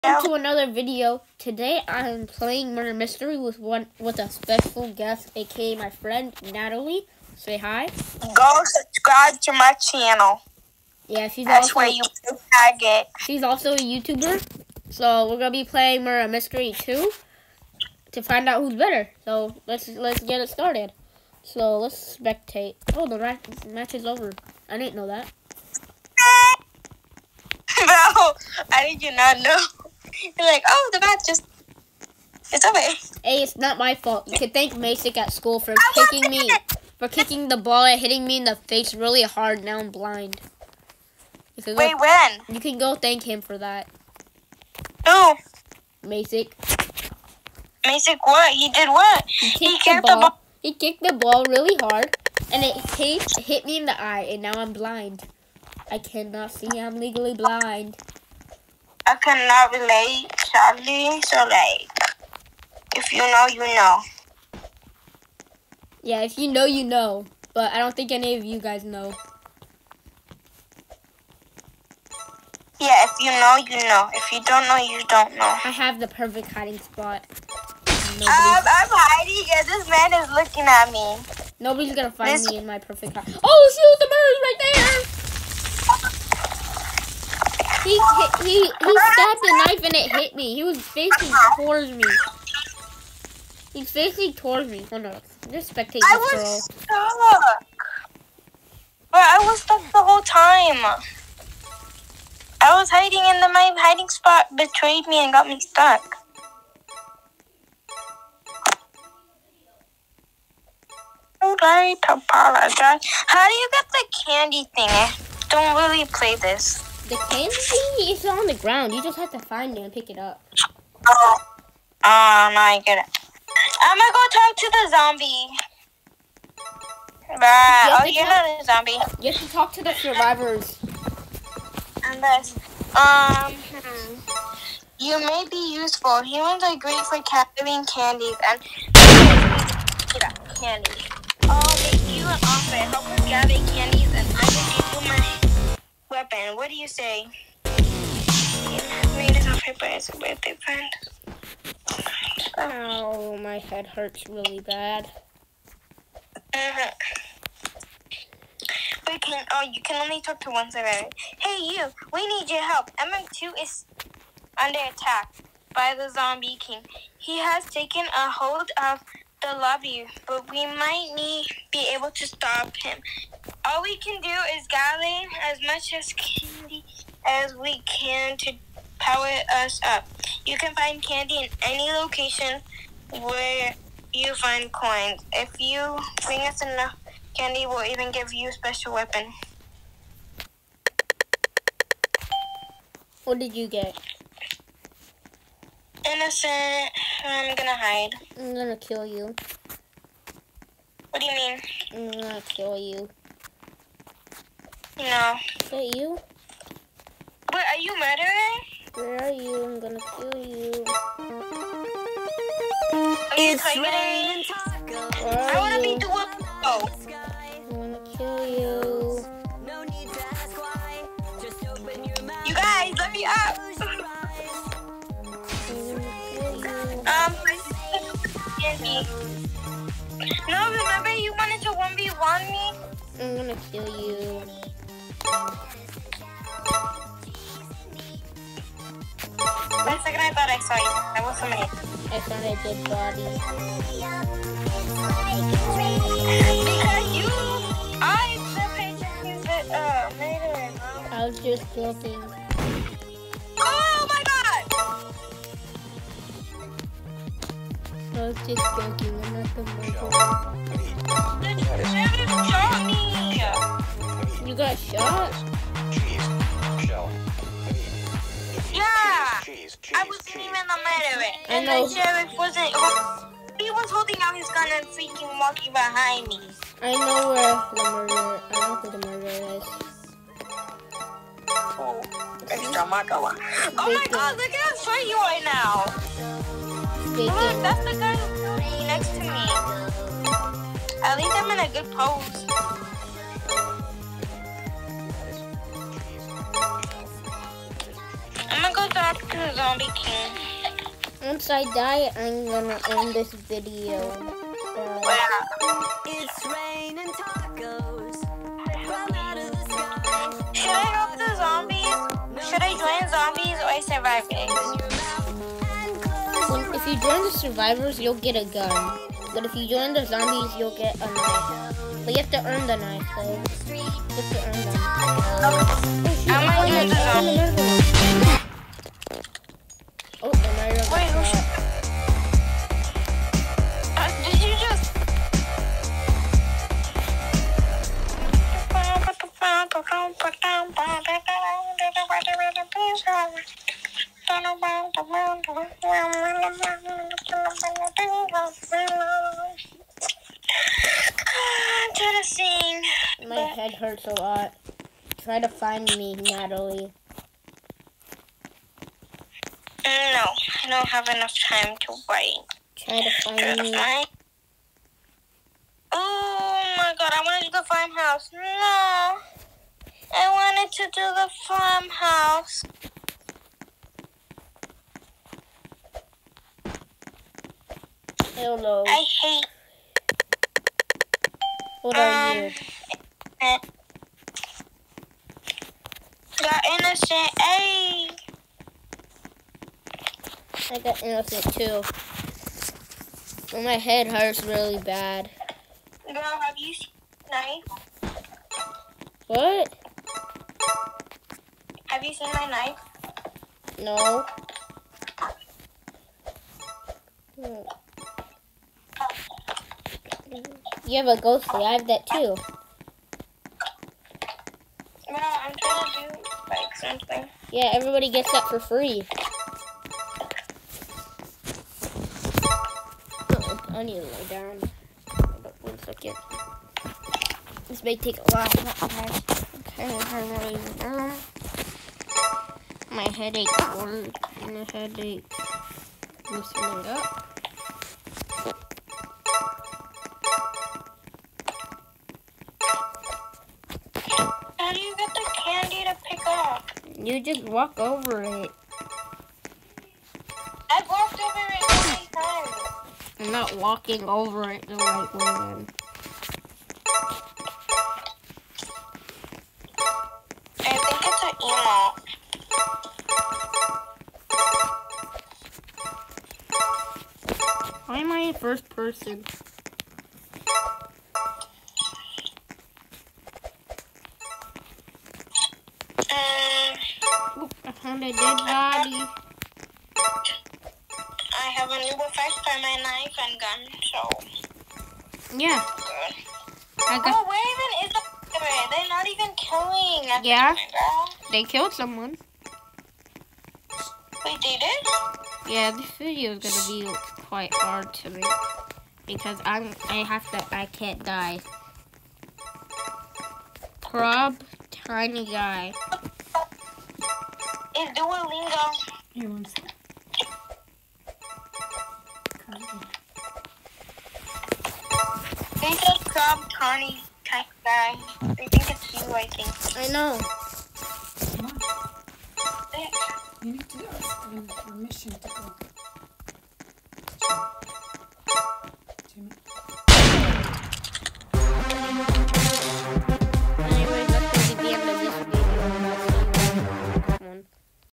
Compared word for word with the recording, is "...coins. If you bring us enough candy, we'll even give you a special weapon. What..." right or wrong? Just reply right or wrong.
right.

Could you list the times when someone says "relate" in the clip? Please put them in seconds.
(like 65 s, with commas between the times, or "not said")
59 s.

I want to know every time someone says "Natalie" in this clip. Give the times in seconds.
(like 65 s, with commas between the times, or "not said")
6 s, 356 s.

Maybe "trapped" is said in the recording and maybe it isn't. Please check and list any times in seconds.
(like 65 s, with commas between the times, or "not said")
not said.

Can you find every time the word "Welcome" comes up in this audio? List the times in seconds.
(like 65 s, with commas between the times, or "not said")
0 s.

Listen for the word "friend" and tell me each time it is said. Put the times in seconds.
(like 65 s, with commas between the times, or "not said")
5 s, 150 s.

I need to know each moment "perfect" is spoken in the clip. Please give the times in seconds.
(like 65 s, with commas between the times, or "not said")
76 s, 82 s.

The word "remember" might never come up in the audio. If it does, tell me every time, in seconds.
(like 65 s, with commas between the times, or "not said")
230 s.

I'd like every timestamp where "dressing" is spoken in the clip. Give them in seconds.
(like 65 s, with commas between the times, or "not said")
not said.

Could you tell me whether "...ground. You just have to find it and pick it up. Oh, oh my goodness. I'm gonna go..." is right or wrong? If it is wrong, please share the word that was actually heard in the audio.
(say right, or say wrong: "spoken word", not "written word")
right.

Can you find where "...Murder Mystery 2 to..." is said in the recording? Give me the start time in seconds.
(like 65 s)
16 s.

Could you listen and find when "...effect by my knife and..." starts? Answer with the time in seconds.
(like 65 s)
481 s.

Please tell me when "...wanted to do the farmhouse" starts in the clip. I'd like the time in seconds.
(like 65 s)
370 s.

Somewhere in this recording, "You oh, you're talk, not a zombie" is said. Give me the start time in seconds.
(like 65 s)
127 s.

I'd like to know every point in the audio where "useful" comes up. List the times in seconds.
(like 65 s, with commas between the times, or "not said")
135 s.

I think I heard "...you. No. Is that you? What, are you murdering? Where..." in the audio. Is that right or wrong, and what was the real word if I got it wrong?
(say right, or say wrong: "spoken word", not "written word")
right.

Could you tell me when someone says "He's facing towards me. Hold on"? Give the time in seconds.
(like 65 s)
93 s.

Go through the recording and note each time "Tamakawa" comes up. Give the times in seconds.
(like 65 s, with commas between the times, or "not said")
282 s.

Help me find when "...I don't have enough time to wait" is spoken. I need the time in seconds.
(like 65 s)
360 s.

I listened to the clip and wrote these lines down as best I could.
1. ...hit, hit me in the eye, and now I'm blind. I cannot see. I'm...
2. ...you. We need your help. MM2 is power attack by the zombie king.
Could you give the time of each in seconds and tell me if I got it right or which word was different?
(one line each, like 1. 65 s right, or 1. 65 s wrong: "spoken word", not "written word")
1. 52 s right
2. 161 s wrong: "under", not "power".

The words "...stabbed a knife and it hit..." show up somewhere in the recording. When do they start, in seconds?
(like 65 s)
89 s.